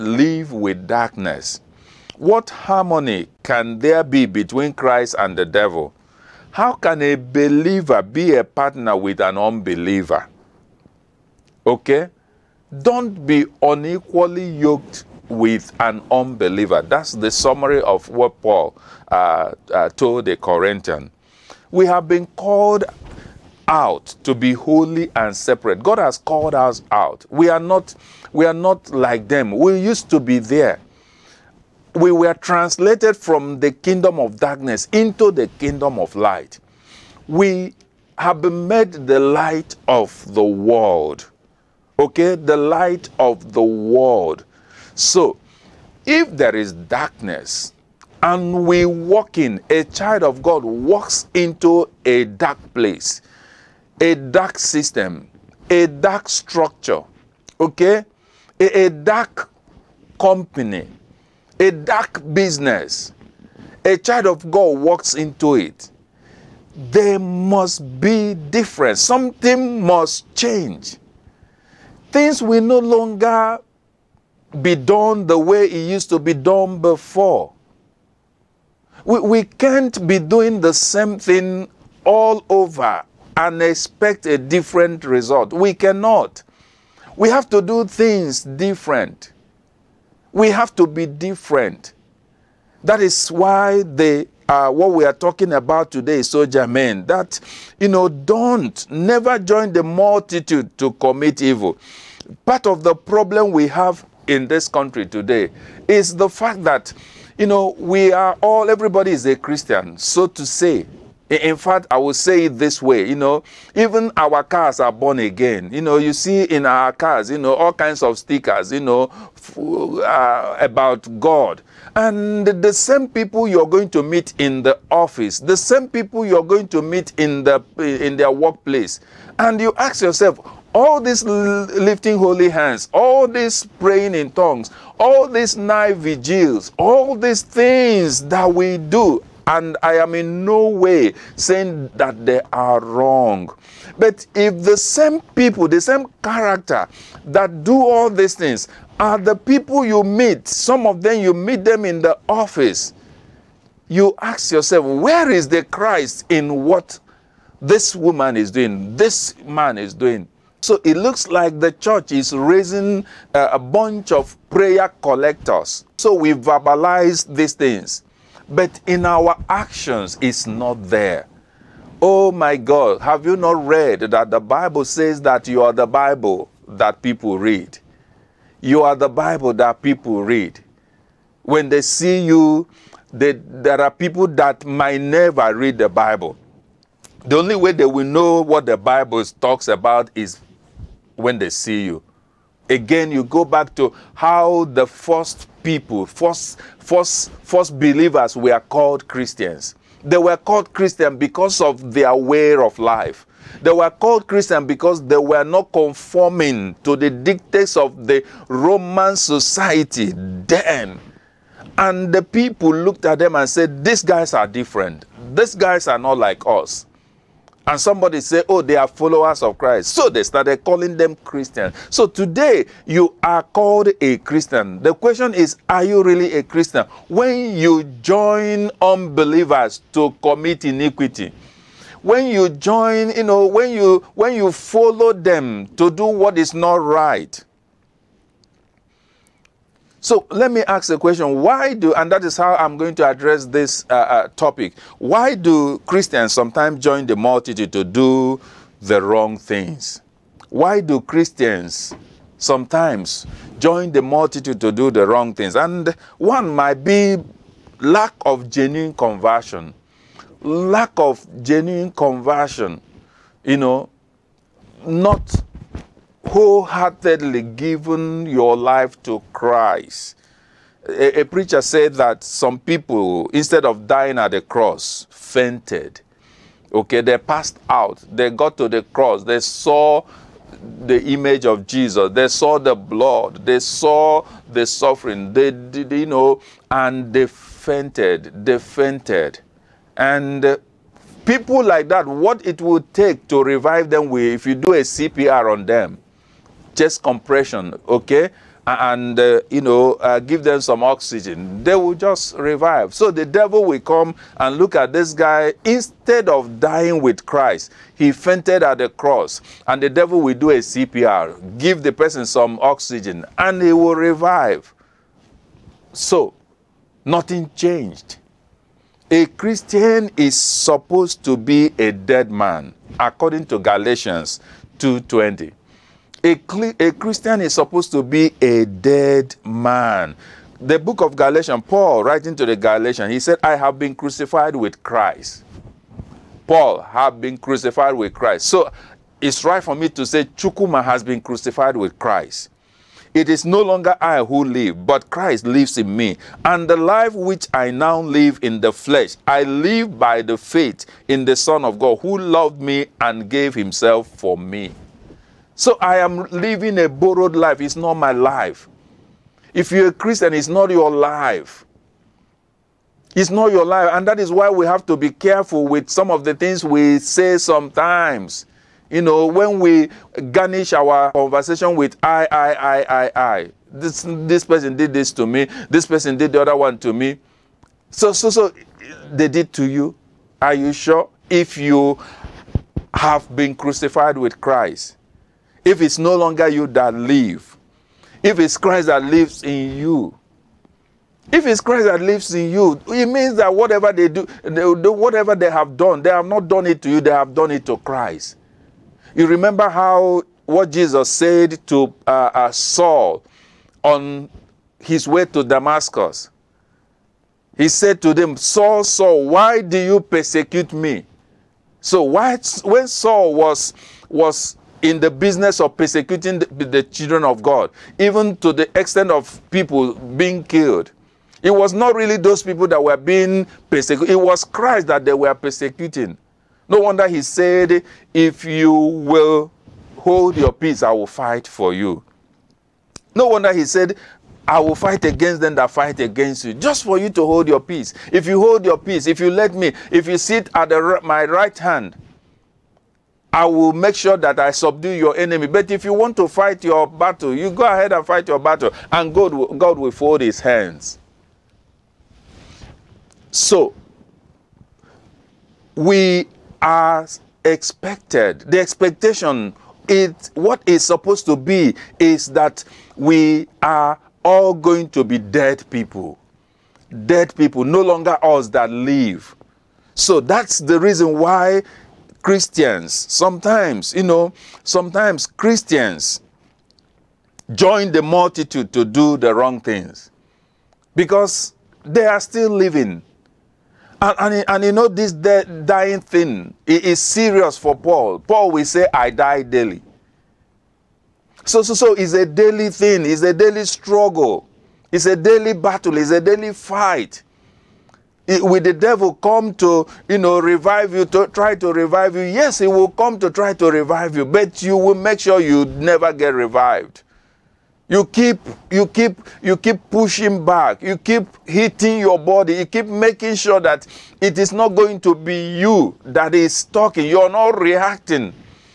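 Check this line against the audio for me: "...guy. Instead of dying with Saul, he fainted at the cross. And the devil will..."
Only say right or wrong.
wrong.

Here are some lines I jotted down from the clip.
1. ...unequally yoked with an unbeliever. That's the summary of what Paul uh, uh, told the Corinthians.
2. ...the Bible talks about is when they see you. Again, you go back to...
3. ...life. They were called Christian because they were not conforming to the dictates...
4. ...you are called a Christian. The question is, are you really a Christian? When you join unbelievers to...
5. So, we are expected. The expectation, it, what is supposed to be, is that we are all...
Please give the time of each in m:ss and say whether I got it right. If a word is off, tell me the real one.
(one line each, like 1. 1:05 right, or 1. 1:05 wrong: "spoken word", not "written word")
1. 0:13 right
2. 3:08 right
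3. 3:22 right
4. 3:42 right
5. 7:33 right.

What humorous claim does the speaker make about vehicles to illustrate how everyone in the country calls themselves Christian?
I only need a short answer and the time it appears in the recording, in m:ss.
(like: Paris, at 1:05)
Even our cars are born again, at 1:53.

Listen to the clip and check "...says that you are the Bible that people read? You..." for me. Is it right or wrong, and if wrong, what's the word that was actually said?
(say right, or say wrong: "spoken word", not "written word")
right.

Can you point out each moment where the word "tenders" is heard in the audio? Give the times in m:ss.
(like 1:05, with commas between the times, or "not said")
not said.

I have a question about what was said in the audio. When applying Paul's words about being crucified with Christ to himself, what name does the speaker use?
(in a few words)
Chukuma.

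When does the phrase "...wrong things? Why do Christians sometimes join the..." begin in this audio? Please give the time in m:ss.
4:09.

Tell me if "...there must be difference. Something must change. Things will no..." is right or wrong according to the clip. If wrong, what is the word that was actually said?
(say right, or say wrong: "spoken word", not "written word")
right.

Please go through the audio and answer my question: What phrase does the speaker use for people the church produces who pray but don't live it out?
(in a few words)
Prayer collectors.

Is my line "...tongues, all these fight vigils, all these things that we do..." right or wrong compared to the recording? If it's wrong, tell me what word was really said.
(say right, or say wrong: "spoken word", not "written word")
wrong: "night", not "fight".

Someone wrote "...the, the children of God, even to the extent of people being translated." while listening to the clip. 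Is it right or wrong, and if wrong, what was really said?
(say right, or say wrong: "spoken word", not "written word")
wrong: "killed", not "translated".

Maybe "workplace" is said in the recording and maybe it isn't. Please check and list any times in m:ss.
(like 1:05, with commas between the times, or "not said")
2:08.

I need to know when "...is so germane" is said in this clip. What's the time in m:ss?
1:36.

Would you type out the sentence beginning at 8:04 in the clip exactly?
And, and, and you know, this dying thing is serious for Paul.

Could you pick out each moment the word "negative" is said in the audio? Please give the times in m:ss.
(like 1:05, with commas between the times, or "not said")
not said.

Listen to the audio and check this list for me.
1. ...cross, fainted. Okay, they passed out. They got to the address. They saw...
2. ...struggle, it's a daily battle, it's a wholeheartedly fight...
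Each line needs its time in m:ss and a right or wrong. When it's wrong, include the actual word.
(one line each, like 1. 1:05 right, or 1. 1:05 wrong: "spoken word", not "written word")
1. 4:34 wrong: "cross", not "address"
2. 8:13 wrong: "daily", not "wholeheartedly".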